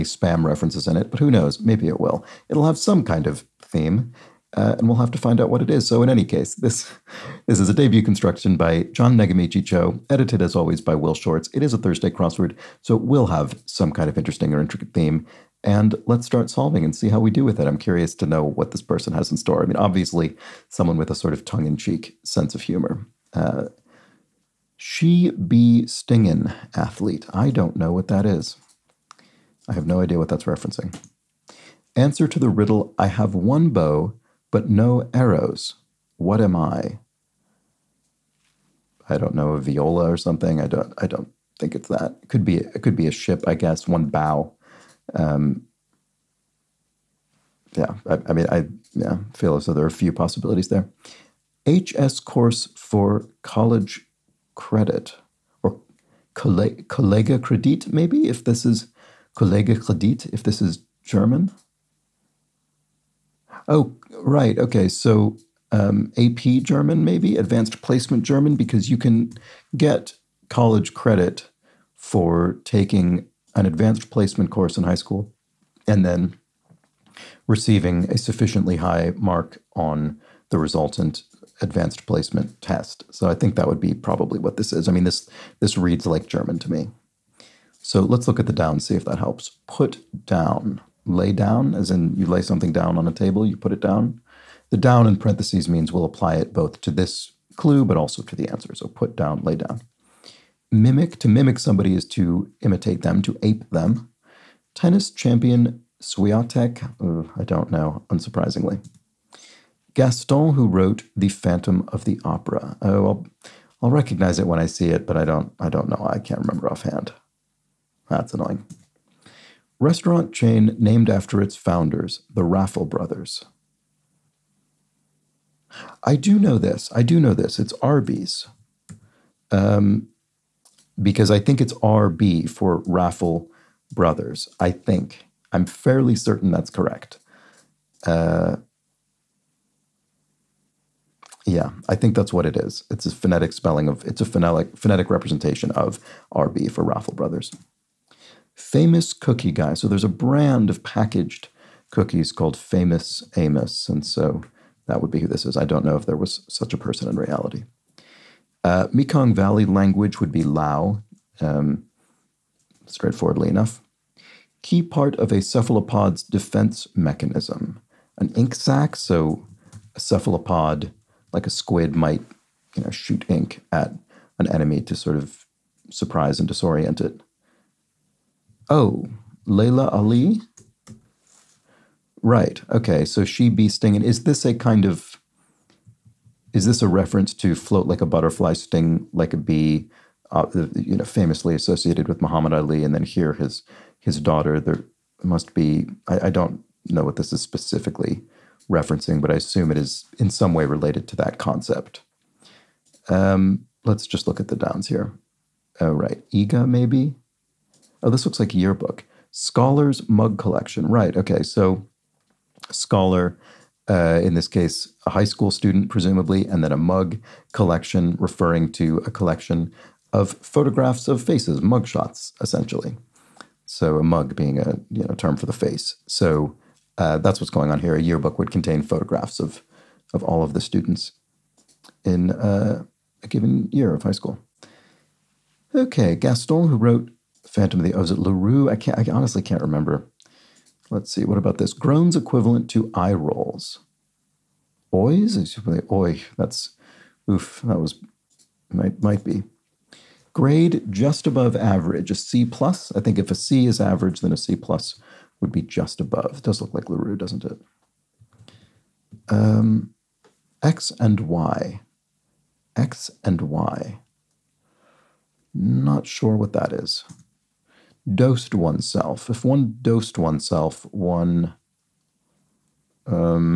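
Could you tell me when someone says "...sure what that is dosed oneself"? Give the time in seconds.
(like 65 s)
266 s.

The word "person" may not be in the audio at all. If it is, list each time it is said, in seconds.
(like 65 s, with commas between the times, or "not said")
18 s, 156 s.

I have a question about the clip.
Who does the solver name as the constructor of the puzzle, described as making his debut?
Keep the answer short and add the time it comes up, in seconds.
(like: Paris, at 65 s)
John Nagamichi Cho, at 8 s.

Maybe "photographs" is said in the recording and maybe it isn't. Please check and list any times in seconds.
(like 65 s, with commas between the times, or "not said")
220 s, 228 s.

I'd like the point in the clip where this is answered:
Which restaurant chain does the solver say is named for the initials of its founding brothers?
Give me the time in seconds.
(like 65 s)
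127 s.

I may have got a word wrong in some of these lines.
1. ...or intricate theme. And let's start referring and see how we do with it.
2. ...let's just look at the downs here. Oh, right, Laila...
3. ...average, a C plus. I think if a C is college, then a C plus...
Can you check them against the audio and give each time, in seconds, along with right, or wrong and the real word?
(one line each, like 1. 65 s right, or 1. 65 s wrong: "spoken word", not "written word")
1. 14 s wrong: "solving", not "referring"
2. 203 s wrong: "Iga", not "Laila"
3. 251 s wrong: "average", not "college".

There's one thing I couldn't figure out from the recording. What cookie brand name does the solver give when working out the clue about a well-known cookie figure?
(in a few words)
Famous Amos.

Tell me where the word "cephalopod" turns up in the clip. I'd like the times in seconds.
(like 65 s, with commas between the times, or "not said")
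165 s, 169 s.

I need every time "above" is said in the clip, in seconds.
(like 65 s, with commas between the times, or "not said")
251 s, 256 s.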